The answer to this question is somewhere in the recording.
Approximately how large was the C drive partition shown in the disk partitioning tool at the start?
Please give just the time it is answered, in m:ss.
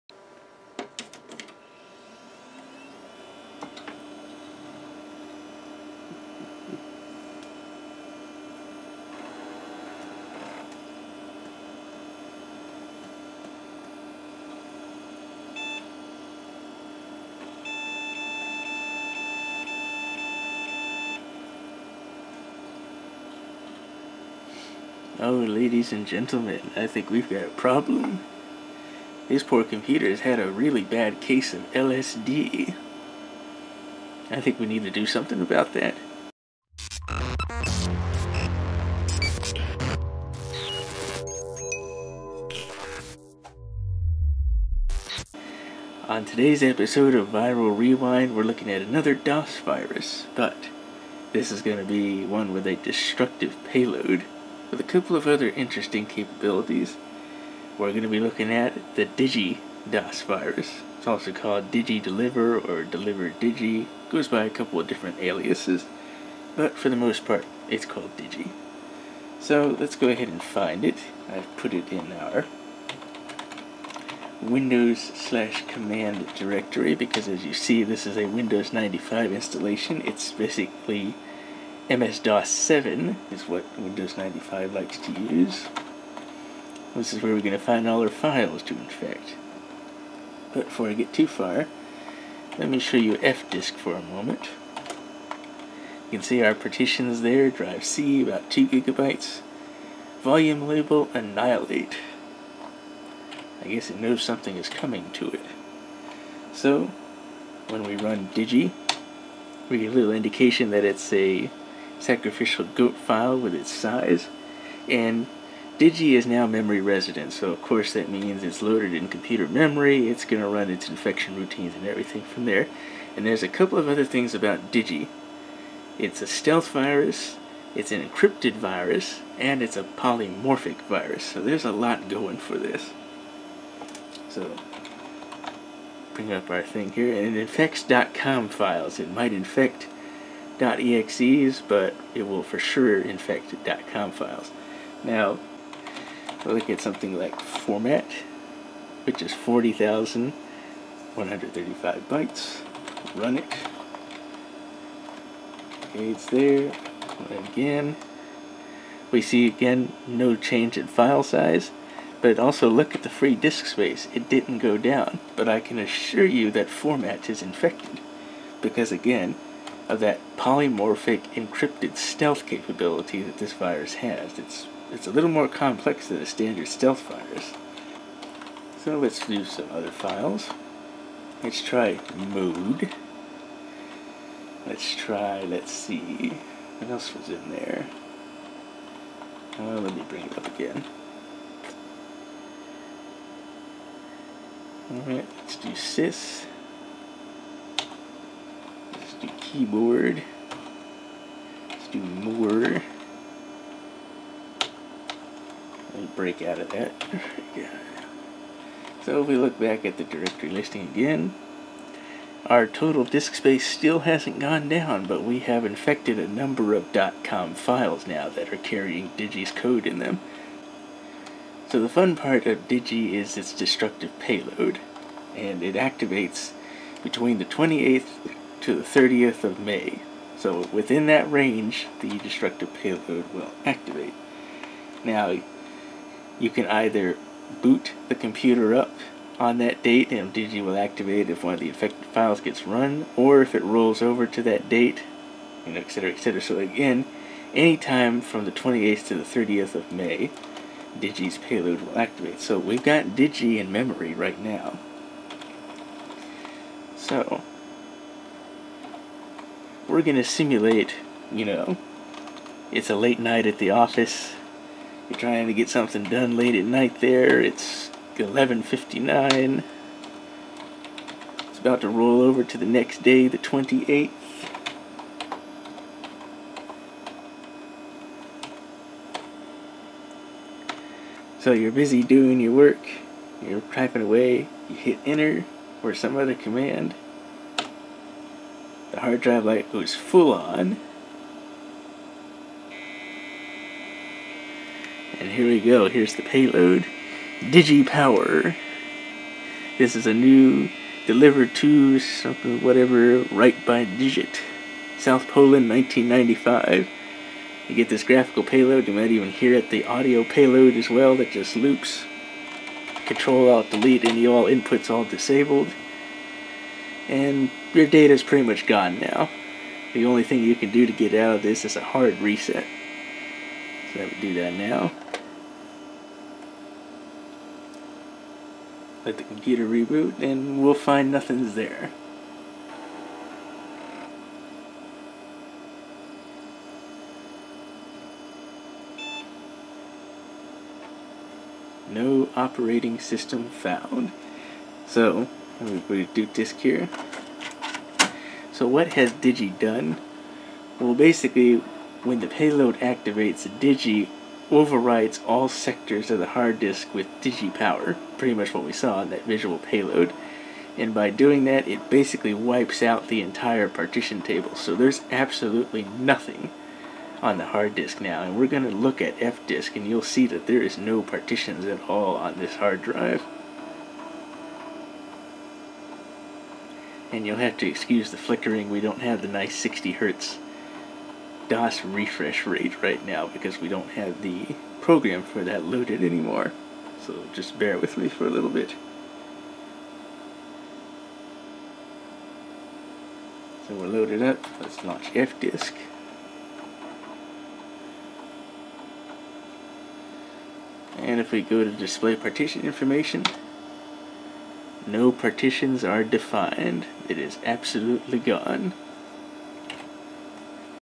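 1:38.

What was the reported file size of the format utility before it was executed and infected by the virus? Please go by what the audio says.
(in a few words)
40,135 bytes.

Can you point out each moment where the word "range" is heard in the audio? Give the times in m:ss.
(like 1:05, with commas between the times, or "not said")
3:51.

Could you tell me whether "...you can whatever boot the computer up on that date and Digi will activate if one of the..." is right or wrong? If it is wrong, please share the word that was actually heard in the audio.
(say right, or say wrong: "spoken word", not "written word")
wrong: "either", not "whatever".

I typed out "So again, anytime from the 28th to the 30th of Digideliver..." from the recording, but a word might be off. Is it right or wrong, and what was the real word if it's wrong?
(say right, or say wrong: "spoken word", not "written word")
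wrong: "May", not "Digideliver".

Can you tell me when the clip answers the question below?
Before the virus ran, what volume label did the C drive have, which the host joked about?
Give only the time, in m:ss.
1:41.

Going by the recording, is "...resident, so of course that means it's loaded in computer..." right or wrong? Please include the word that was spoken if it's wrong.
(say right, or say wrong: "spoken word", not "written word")
right.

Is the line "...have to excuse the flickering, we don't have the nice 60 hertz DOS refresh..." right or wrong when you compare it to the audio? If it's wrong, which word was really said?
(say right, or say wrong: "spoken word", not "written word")
right.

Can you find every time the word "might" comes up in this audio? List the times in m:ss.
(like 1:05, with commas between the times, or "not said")
2:19, 5:08.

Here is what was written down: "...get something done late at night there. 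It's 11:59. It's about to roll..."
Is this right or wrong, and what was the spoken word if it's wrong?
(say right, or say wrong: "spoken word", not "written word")
right.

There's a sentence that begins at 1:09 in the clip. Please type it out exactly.
So let's go ahead and find it.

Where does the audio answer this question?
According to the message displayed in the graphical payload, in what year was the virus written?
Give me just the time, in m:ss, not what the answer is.
5:05.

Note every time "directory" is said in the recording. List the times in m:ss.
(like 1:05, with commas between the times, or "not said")
1:16, 3:30.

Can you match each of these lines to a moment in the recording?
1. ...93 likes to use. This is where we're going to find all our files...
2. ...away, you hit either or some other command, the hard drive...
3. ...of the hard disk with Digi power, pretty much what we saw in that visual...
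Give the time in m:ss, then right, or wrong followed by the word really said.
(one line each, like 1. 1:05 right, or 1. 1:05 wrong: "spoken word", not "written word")
1. 1:24 wrong: "95", not "93"
2. 4:44 wrong: "enter", not "either"
3. 5:56 right.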